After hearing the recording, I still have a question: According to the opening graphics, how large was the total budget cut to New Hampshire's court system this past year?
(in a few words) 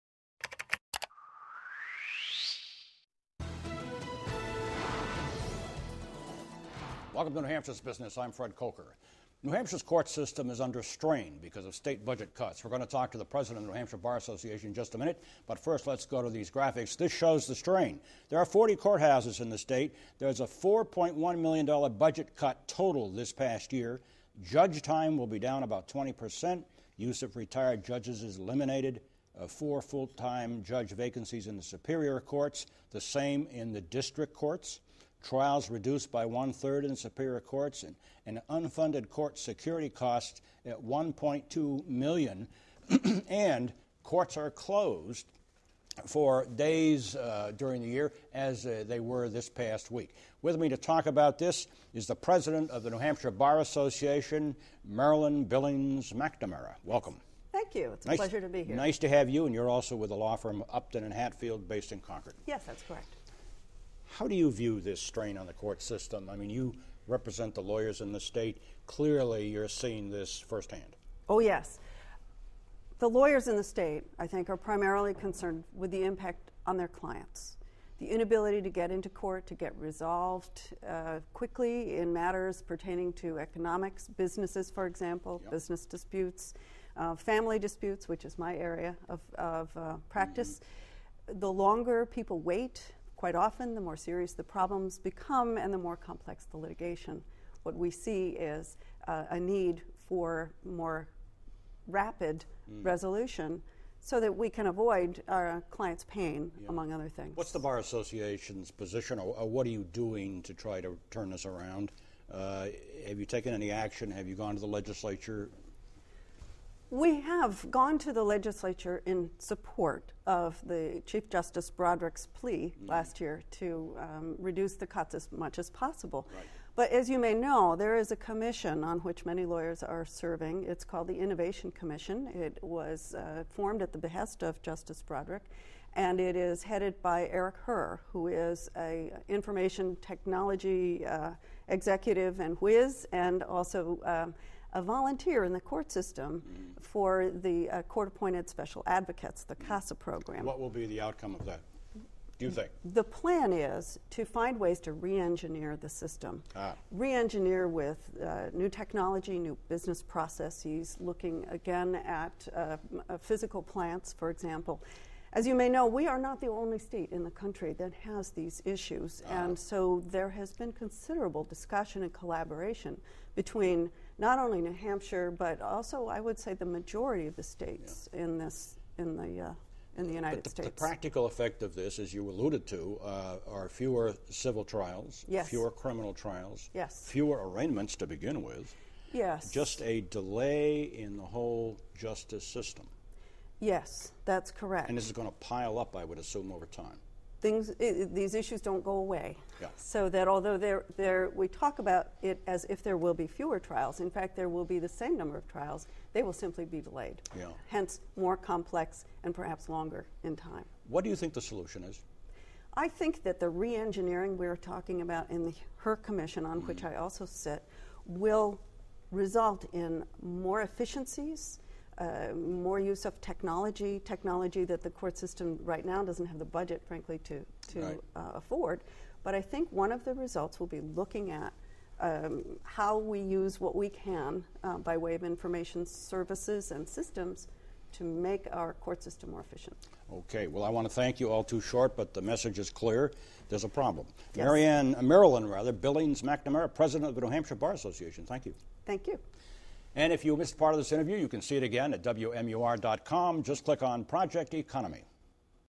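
$4.1 million.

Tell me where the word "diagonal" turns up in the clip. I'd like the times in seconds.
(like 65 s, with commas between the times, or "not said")
not said.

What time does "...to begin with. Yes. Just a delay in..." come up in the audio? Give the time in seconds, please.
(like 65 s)
187 s.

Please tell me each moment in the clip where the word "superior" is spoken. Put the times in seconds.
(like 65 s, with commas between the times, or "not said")
31 s, 36 s.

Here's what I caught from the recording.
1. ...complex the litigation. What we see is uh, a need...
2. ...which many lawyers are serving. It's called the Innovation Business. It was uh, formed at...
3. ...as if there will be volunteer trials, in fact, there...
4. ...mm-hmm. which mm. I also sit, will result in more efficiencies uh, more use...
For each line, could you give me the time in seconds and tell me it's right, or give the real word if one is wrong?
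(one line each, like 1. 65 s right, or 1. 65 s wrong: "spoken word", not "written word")
1. 95 s right
2. 128 s wrong: "Commission", not "Business"
3. 202 s wrong: "fewer", not "volunteer"
4. 216 s right.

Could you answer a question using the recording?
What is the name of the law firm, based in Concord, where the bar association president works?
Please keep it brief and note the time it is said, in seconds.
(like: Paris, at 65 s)
Upton and Hatfield, at 60 s.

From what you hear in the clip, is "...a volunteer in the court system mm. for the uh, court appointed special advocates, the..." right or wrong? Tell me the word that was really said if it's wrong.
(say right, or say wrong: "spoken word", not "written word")
right.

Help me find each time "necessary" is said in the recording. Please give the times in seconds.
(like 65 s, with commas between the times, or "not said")
not said.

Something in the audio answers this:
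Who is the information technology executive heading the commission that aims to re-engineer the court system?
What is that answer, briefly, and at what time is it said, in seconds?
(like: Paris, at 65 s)
Eric Herr, at 137 s.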